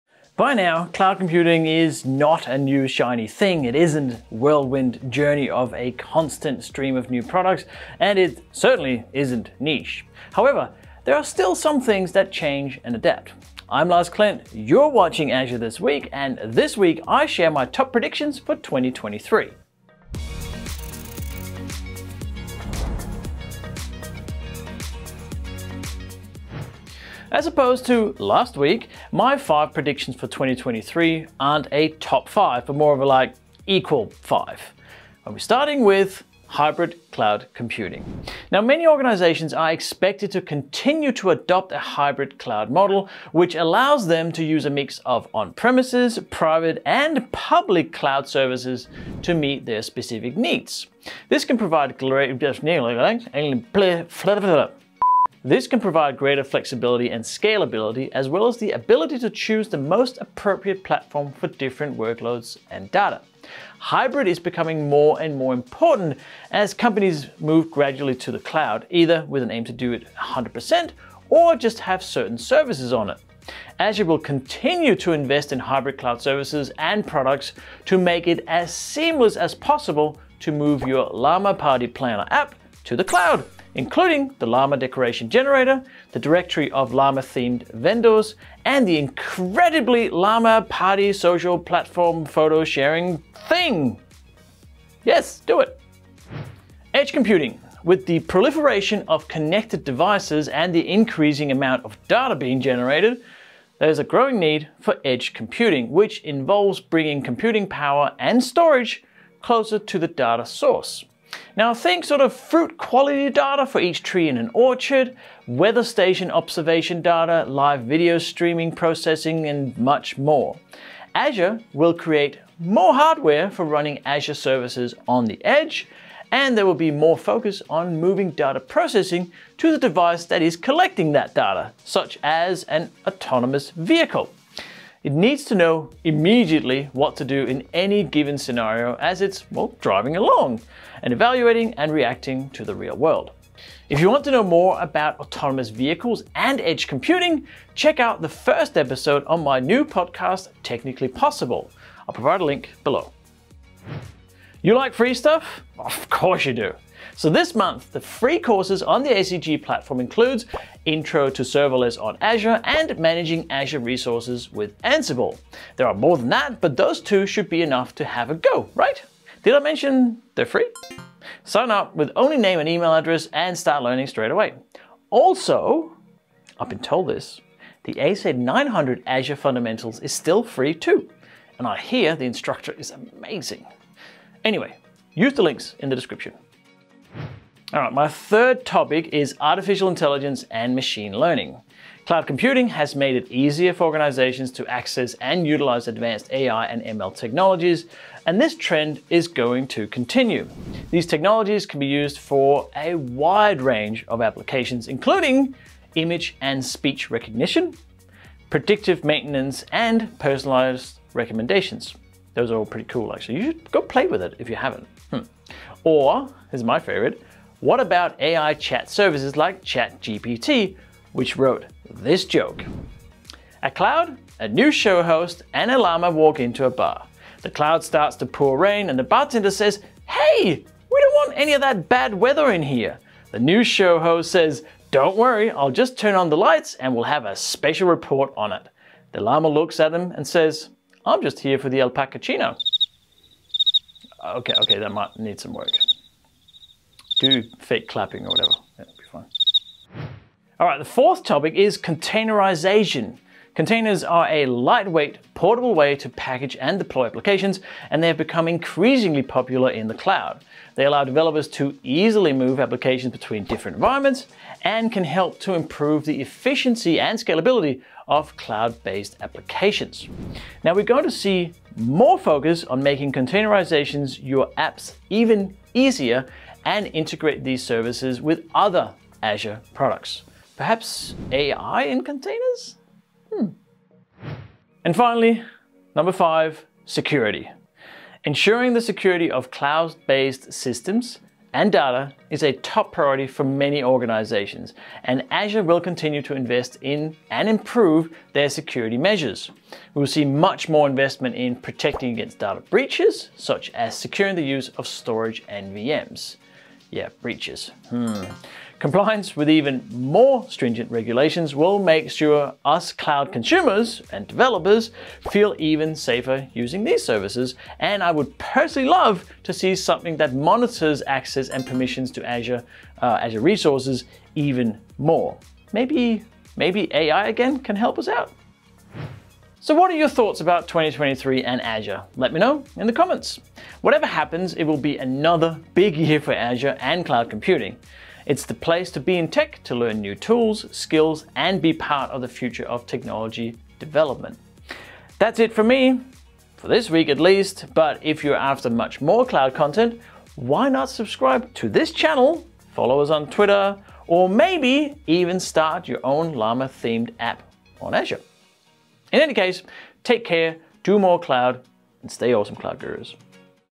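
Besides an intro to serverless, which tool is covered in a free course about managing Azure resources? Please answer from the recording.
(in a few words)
Ansible.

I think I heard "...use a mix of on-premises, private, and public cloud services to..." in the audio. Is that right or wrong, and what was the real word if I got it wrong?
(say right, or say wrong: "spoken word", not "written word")
right.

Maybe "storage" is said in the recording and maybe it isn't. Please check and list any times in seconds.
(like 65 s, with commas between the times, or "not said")
108 s, 304 s.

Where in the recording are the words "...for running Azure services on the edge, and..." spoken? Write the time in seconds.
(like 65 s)
123 s.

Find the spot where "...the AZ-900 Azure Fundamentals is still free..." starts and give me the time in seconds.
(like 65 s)
177 s.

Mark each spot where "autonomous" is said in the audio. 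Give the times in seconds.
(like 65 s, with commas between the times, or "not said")
133 s, 145 s.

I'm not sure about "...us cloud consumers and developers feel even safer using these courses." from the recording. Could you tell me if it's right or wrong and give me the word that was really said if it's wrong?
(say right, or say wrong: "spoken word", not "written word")
wrong: "services", not "courses".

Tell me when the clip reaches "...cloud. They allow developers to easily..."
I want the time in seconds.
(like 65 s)
259 s.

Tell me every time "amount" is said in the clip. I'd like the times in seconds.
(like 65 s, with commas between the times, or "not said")
101 s.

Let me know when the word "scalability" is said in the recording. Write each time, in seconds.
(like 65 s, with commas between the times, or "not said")
57 s, 267 s.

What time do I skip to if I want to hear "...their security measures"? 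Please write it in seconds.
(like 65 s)
298 s.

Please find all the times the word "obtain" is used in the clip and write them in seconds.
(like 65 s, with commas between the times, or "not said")
not said.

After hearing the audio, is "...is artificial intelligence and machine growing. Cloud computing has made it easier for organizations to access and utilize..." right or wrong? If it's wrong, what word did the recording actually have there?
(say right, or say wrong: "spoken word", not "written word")
wrong: "learning", not "growing".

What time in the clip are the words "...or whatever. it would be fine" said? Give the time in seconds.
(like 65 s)
248 s.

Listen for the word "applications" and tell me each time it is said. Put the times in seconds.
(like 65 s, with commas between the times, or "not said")
204 s, 257 s, 262 s, 269 s.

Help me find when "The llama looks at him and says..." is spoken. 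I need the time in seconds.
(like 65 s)
239 s.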